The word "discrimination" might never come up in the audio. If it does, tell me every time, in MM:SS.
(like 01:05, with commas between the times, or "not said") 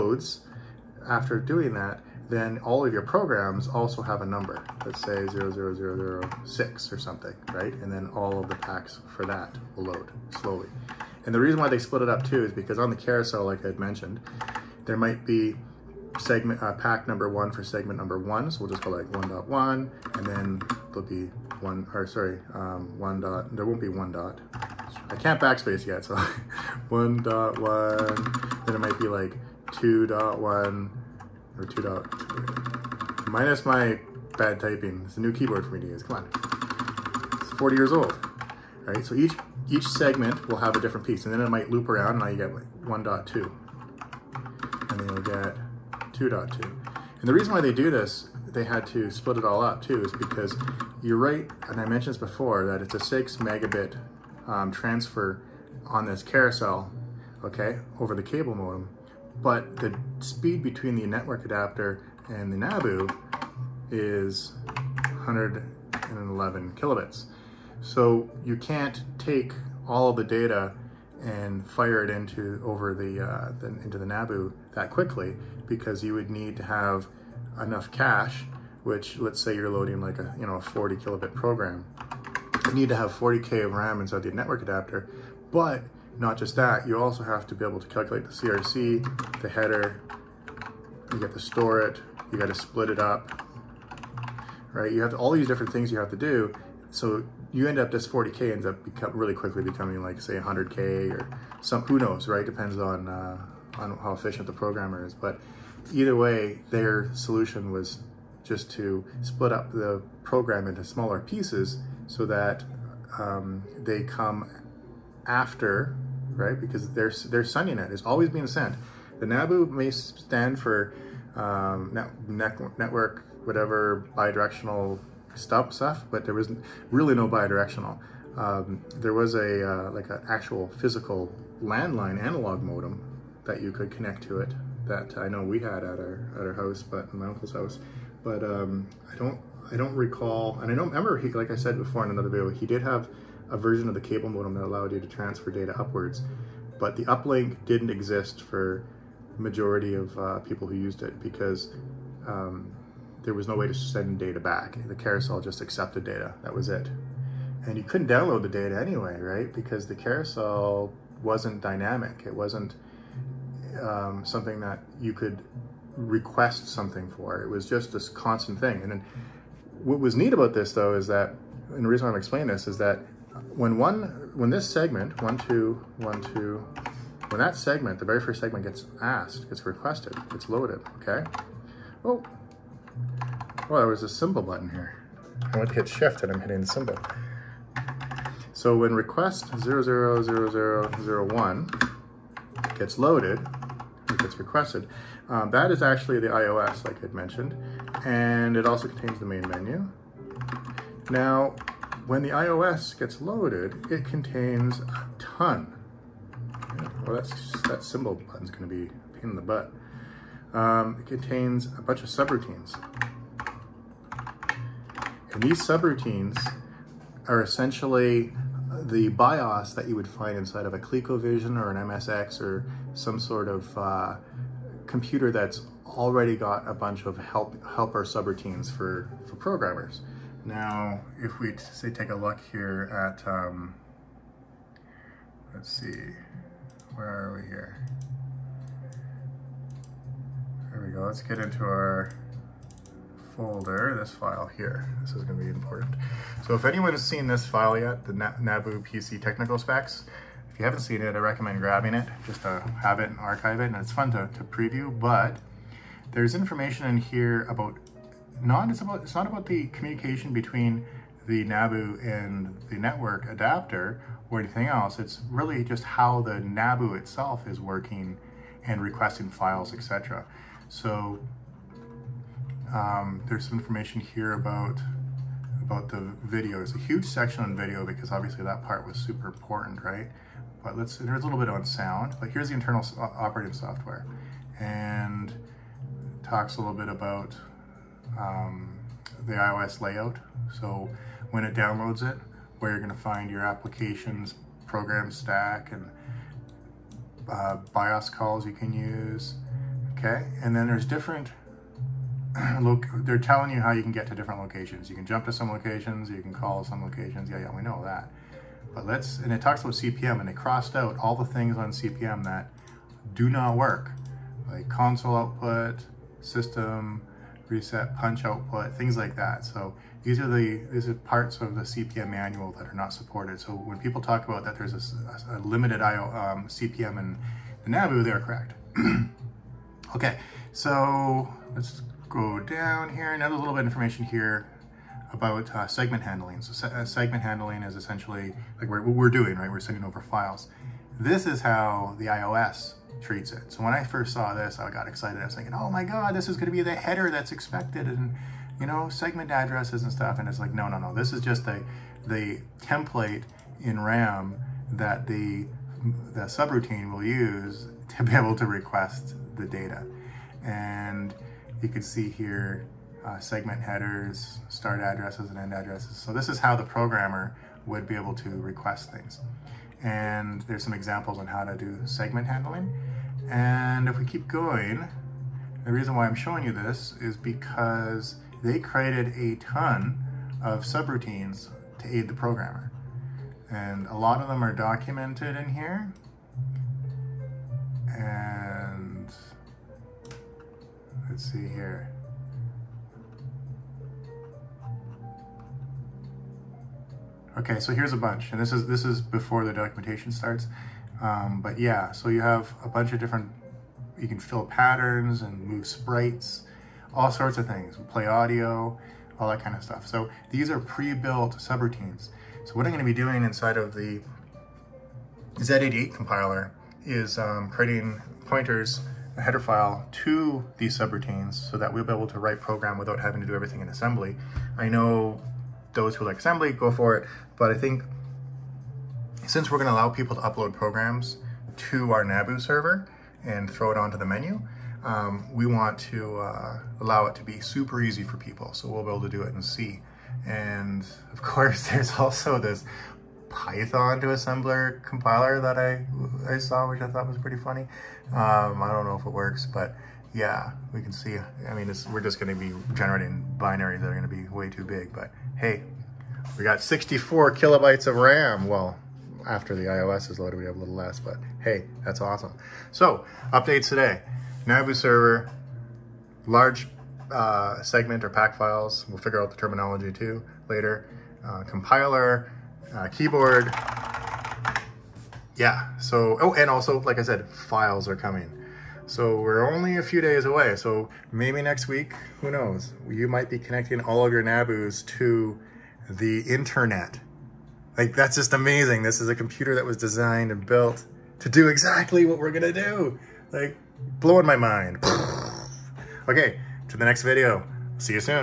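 not said.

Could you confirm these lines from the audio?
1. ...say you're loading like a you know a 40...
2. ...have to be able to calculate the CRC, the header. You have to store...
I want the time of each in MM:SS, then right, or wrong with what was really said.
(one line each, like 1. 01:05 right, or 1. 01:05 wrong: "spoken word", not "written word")
1. 01:19 right
2. 01:27 right.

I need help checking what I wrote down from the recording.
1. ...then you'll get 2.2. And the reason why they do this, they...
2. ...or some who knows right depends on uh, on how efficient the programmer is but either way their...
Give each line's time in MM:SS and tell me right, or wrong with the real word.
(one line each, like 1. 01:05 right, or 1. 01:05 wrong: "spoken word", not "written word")
1. 00:45 right
2. 01:41 right.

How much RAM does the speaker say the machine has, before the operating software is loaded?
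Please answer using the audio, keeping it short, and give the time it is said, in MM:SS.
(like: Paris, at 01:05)
64 kilobytes, at 07:36.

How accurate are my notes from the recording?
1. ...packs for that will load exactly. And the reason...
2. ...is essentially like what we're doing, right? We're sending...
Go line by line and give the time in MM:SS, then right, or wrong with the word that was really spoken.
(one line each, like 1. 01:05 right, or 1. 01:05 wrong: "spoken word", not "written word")
1. 00:08 wrong: "slowly", not "exactly"
2. 05:37 right.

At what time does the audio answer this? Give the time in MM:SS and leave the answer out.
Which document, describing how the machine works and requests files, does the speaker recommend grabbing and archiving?
04:08.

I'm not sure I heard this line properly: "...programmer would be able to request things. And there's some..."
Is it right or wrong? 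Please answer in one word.
right.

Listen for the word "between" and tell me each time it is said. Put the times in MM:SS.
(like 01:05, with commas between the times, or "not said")
01:00, 04:20.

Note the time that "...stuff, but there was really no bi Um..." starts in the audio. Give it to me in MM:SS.
02:05.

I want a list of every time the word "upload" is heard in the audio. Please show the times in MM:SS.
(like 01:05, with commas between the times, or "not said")
07:10.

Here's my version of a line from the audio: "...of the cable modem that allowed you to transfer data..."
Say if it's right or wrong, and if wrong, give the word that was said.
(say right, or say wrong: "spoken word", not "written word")
right.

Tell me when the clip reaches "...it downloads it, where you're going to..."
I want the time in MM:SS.
04:51.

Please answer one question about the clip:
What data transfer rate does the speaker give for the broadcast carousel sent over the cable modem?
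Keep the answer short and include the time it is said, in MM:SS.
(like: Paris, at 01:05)
6 megabit, at 00:52.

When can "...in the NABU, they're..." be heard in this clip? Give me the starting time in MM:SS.
05:26.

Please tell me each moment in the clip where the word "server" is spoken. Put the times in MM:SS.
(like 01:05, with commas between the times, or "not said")
07:12, 07:44.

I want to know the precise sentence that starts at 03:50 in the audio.
Now, if we say take a look here at, um, let's see, where are we here?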